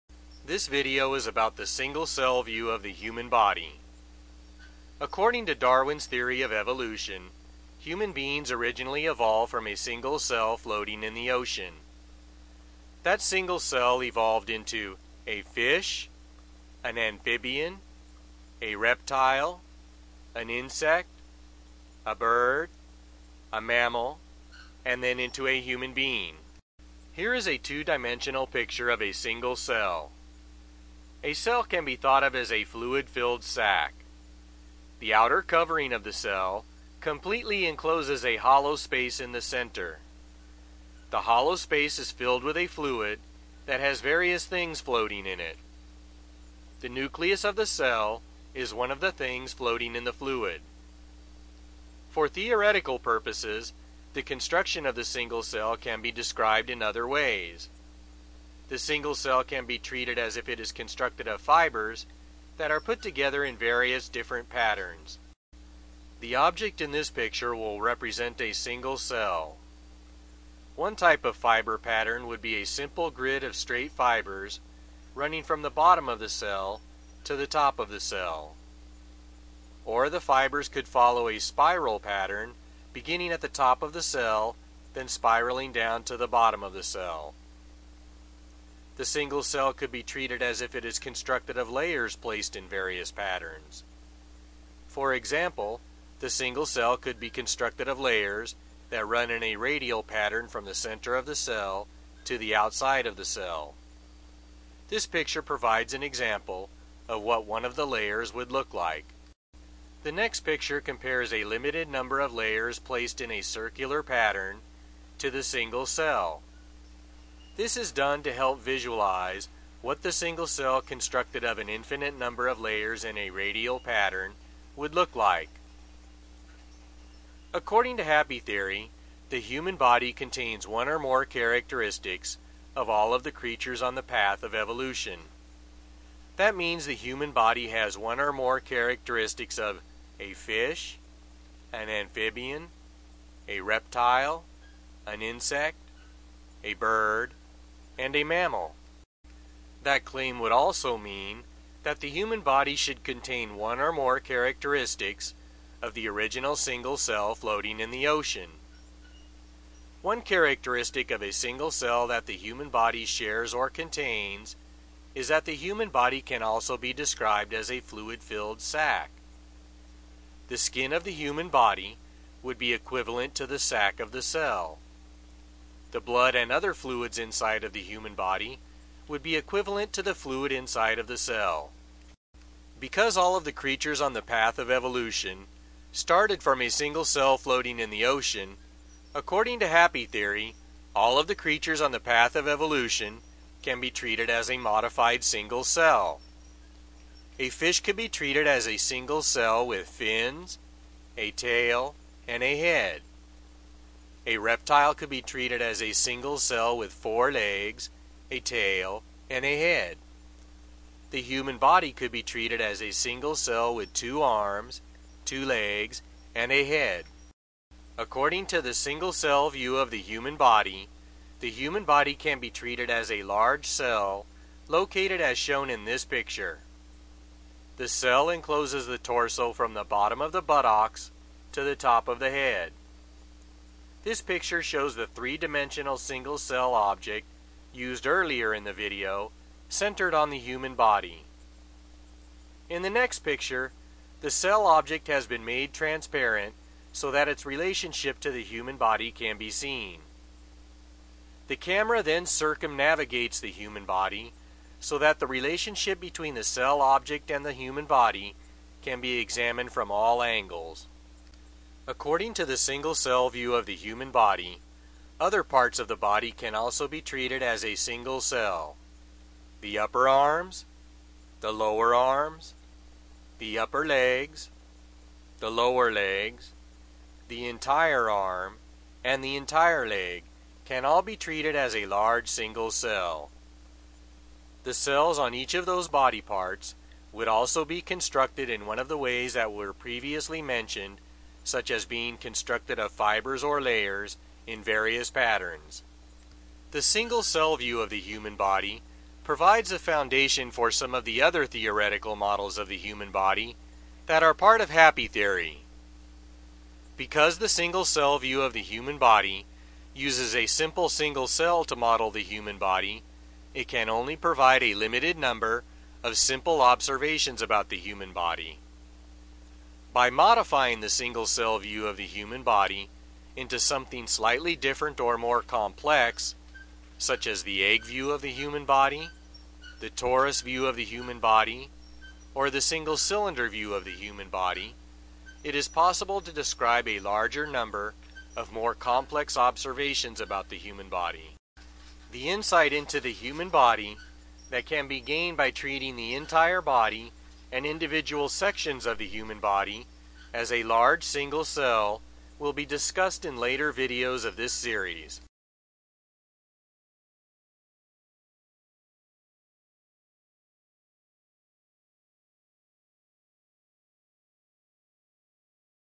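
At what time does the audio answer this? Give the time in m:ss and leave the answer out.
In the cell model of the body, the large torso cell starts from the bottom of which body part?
3:50.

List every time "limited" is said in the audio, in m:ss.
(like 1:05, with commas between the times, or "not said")
1:51, 5:14.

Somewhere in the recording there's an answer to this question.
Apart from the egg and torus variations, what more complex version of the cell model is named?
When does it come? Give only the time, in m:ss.
5:32.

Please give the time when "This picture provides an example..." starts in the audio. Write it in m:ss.
1:44.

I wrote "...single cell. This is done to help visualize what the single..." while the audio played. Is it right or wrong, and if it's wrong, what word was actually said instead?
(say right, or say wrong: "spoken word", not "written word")
right.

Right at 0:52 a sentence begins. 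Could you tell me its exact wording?
For theoretical purposes, the construction of the single cell can be described in other ways.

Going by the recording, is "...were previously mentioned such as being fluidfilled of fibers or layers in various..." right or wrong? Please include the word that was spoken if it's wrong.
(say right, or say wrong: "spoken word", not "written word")
wrong: "constructed", not "fluidfilled".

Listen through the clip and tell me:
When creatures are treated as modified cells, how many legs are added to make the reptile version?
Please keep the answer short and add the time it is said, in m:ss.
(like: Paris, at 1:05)
4, at 3:26.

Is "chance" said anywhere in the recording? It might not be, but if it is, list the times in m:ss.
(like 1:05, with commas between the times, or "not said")
not said.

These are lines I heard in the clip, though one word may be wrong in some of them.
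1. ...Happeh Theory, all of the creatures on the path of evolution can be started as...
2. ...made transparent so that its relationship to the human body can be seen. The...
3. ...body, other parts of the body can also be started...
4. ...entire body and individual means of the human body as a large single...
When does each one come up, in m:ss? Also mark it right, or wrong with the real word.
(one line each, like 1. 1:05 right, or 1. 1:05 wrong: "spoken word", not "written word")
1. 3:09 wrong: "treated", not "started"
2. 4:05 right
3. 4:24 wrong: "treated", not "started"
4. 5:46 wrong: "sections", not "means".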